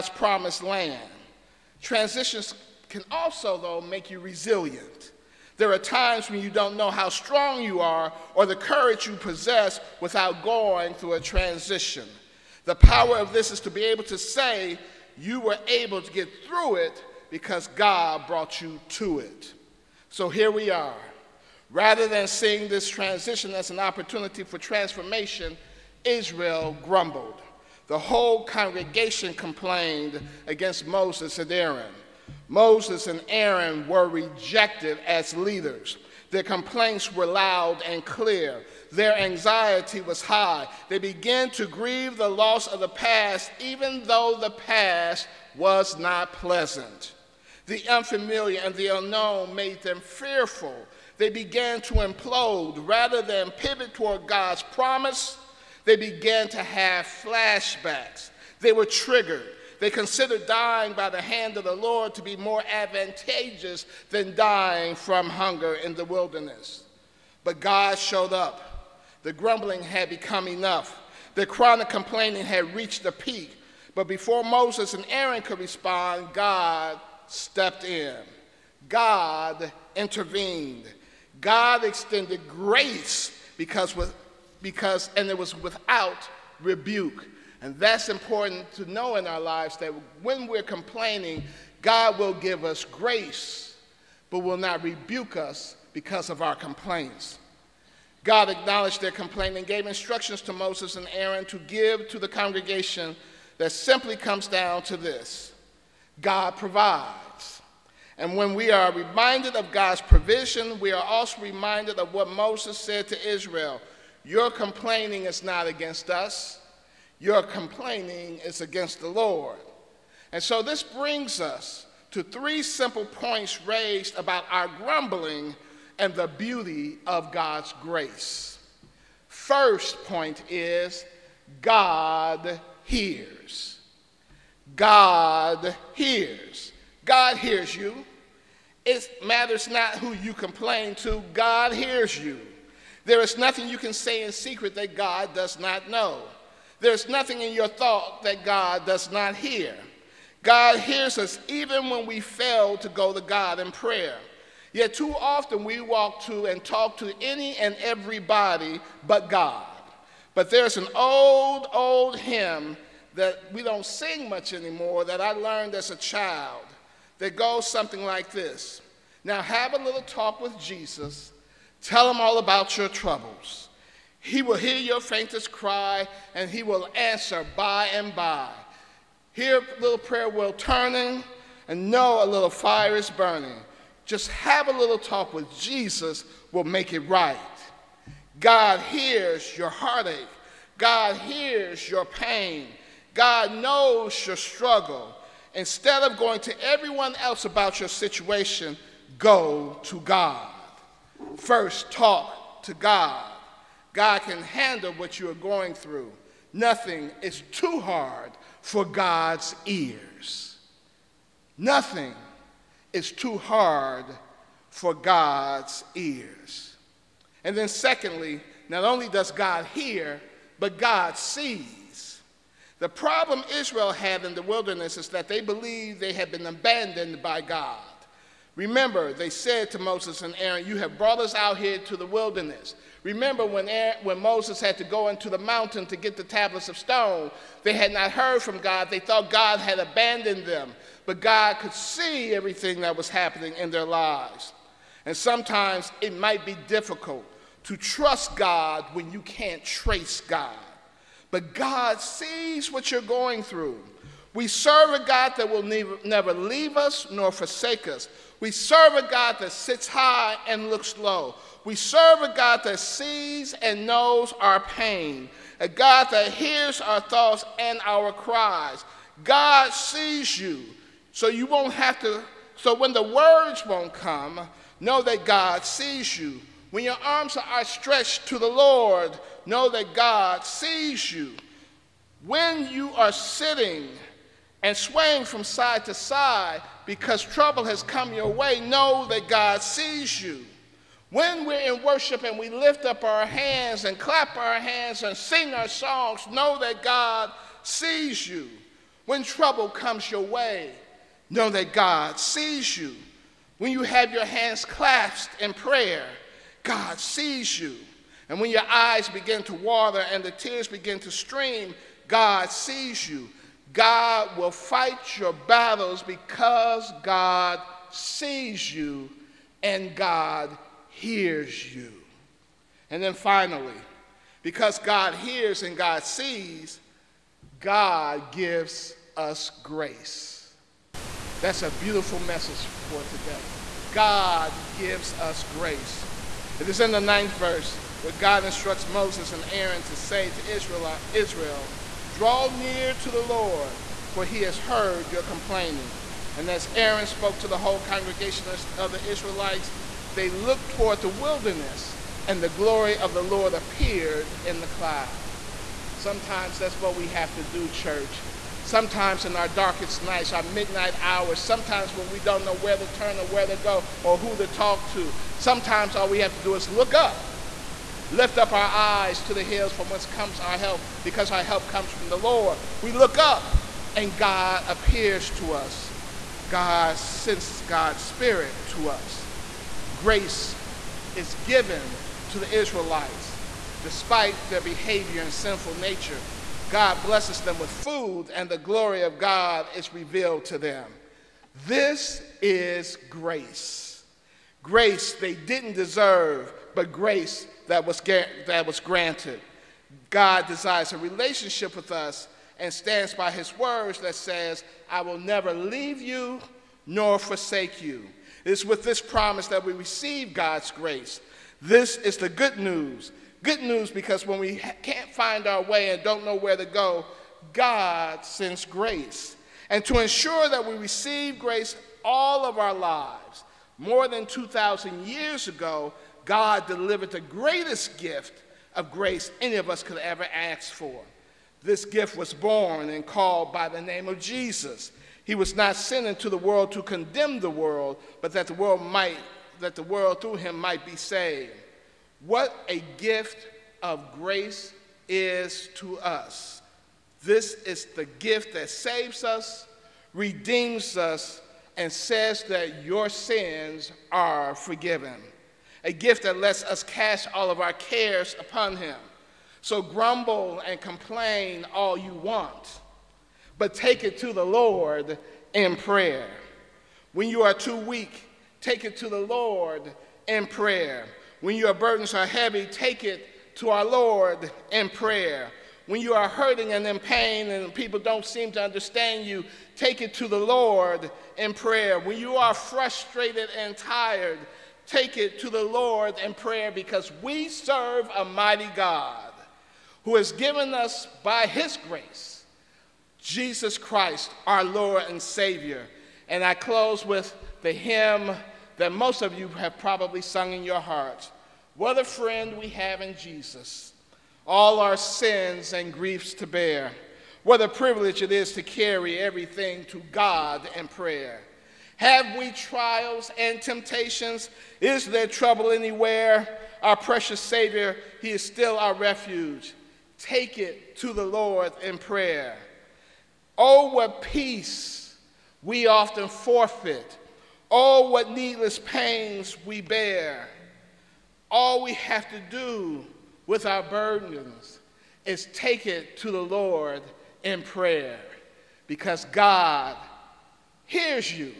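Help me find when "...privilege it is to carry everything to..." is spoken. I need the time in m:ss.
8:27.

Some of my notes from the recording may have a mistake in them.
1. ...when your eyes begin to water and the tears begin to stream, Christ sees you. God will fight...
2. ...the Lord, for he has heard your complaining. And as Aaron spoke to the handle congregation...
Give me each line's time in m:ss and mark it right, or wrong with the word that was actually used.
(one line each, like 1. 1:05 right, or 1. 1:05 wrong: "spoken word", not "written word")
1. 5:08 wrong: "God", not "Christ"
2. 5:43 wrong: "whole", not "handle".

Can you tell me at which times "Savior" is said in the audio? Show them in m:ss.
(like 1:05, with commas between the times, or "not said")
8:15, 8:37.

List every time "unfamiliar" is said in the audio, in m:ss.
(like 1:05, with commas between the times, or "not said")
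0:47.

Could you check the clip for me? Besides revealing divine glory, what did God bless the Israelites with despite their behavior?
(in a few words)
food.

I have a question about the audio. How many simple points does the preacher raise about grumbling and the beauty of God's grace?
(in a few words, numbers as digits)
3.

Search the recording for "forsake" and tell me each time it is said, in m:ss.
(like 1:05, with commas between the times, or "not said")
4:17, 6:47.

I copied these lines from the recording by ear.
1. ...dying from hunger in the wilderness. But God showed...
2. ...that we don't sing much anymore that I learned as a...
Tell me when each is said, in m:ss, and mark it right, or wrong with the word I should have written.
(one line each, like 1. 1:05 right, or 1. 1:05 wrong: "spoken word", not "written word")
1. 1:04 right
2. 2:43 right.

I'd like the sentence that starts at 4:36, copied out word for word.
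When your arms are outstretched to the Lord, know that God sees you.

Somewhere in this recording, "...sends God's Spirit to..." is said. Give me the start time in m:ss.
6:16.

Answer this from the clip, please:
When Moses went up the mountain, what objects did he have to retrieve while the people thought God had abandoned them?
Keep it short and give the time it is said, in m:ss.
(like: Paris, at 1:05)
tablets of stone, at 3:56.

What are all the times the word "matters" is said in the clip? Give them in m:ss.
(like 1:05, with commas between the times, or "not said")
2:19.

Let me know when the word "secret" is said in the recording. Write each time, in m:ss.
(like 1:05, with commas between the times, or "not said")
2:24.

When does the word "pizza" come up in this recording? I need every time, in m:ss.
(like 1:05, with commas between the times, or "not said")
not said.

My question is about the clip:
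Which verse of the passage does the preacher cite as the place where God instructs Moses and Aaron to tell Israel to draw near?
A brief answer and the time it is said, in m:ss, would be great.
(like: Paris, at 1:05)
ninth verse, at 5:36.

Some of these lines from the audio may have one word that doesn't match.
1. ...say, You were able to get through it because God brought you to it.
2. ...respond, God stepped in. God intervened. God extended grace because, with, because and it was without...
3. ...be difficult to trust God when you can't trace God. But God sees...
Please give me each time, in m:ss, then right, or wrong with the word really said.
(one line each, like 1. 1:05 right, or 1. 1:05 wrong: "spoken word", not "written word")
1. 0:14 right
2. 1:15 right
3. 4:06 right.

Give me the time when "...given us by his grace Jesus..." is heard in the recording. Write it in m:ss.
8:10.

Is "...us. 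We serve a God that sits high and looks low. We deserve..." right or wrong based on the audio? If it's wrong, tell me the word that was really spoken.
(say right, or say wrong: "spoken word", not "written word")
wrong: "serve", not "deserve".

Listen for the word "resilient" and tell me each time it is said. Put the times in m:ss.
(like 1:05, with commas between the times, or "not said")
0:04.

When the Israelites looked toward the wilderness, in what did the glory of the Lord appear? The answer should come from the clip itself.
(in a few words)
the cloud.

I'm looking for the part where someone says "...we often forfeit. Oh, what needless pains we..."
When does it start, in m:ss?
8:45.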